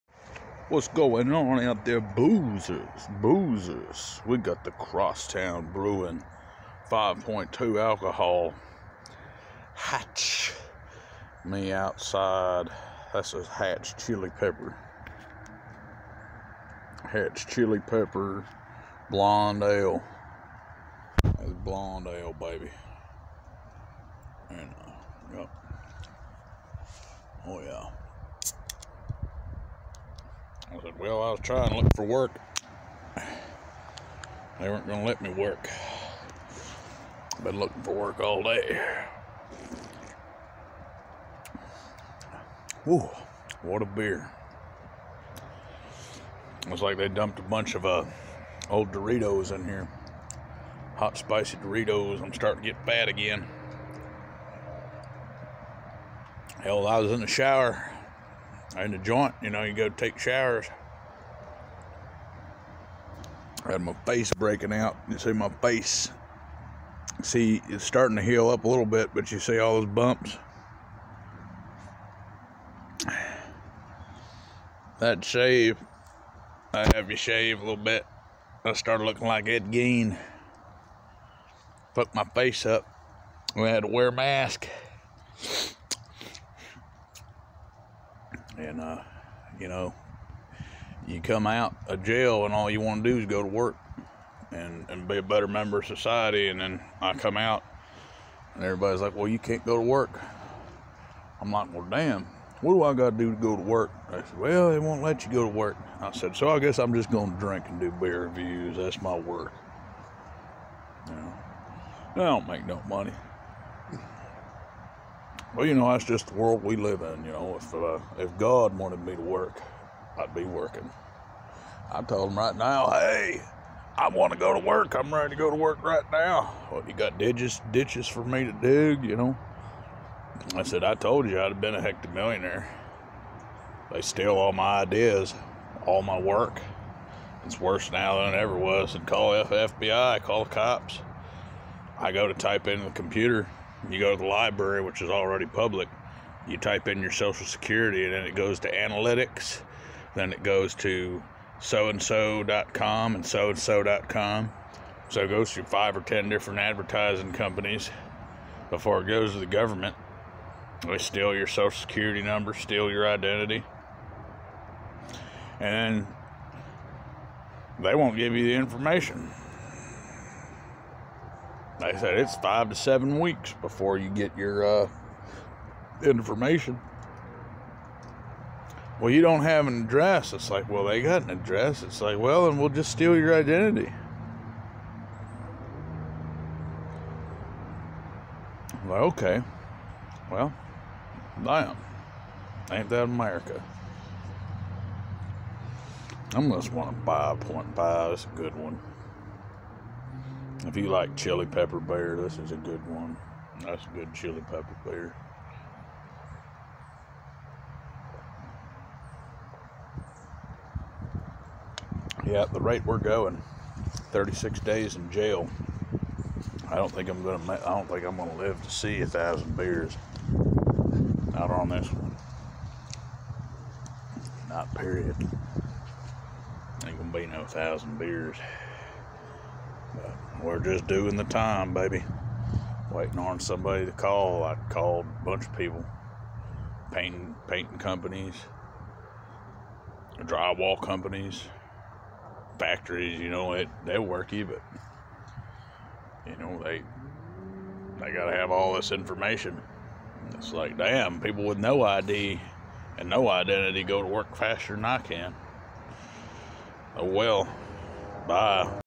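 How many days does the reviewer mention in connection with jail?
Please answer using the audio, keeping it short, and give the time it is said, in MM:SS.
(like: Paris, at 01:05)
36, at 03:34.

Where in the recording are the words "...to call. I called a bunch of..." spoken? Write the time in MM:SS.
03:53.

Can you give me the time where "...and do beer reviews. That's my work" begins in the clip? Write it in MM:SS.
01:47.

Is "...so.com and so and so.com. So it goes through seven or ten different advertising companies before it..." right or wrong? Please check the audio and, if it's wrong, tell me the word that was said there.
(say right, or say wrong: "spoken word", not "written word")
wrong: "five", not "seven".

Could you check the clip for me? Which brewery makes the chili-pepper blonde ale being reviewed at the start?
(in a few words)
Crosstown Brewing.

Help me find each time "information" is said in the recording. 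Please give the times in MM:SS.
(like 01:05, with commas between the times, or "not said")
02:48, 02:56, 04:08.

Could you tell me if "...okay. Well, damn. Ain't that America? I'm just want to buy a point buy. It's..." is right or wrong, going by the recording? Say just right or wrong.
right.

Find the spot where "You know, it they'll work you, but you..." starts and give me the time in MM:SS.
04:03.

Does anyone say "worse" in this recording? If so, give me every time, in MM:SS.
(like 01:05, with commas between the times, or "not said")
02:17.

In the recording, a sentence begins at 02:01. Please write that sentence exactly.
I told him right now, hey, I want to go to work.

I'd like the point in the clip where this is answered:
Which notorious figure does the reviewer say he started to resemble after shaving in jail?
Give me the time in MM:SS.
01:19.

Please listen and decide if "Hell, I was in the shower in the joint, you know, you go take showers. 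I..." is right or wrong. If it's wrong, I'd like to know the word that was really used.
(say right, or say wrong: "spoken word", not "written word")
right.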